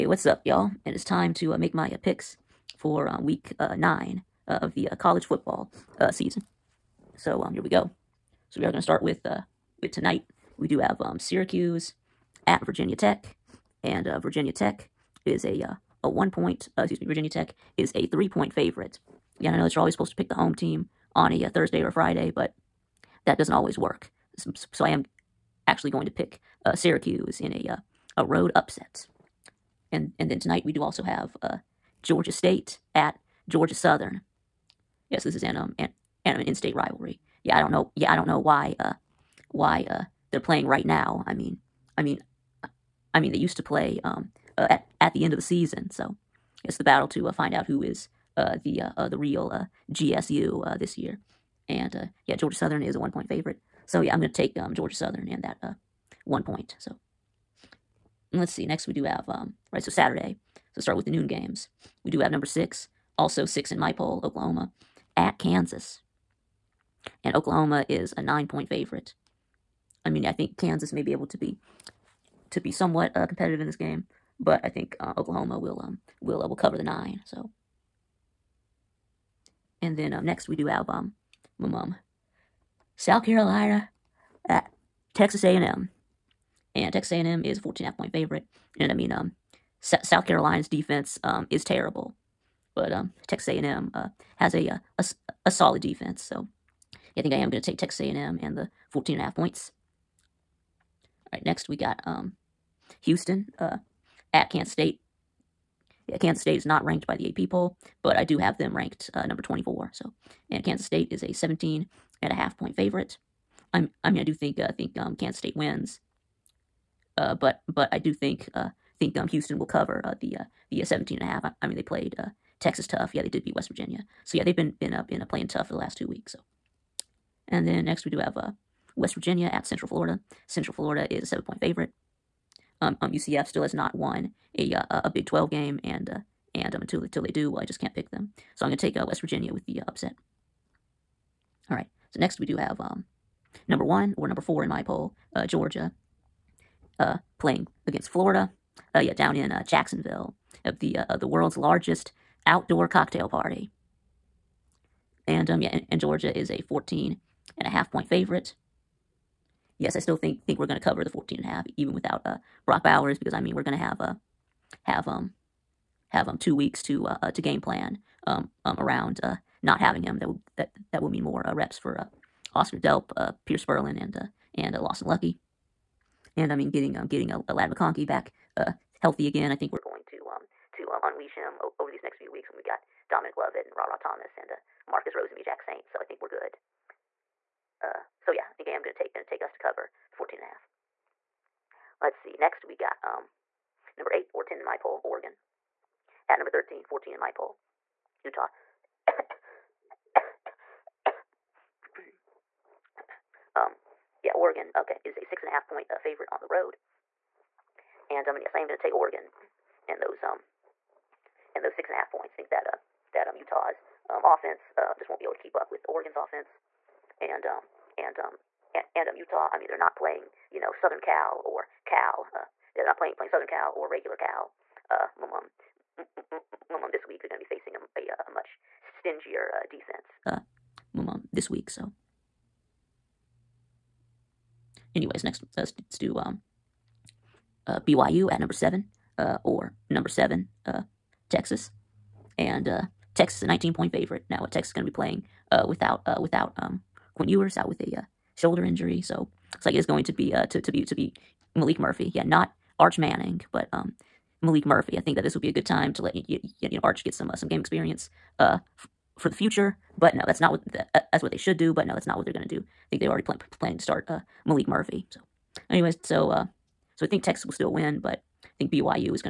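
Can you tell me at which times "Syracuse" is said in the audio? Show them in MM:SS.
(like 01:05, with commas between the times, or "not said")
00:11, 00:26.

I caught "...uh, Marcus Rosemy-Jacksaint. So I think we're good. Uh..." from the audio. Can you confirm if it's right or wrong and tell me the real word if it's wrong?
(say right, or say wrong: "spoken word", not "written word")
right.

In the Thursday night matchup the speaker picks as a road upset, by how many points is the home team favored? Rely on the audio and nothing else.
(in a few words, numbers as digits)
3.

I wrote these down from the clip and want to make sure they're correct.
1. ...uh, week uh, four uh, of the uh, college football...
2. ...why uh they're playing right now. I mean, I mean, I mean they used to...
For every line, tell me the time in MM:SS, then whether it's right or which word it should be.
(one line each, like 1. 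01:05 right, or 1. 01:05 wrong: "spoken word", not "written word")
1. 00:03 wrong: "nine", not "four"
2. 00:39 right.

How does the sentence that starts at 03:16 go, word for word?
At number 13, 14 in my poll, Utah.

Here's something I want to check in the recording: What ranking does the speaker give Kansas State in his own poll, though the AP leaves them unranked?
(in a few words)
24.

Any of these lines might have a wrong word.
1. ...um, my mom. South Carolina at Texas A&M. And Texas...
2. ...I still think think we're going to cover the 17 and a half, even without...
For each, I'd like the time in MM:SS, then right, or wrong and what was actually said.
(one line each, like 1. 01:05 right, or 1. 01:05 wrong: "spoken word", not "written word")
1. 01:20 right
2. 02:39 wrong: "14", not "17".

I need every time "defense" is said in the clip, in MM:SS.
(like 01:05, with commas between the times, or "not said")
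01:30, 01:35, 03:49.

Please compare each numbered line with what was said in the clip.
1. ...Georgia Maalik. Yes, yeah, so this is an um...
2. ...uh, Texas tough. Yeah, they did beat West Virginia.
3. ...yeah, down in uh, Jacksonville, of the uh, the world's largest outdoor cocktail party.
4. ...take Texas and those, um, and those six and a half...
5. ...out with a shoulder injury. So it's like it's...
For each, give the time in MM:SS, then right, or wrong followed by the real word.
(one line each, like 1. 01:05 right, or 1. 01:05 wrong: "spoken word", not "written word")
1. 00:33 wrong: "Southern", not "Maalik"
2. 02:02 right
3. 02:28 right
4. 03:28 wrong: "Oregon", not "Texas"
5. 04:07 right.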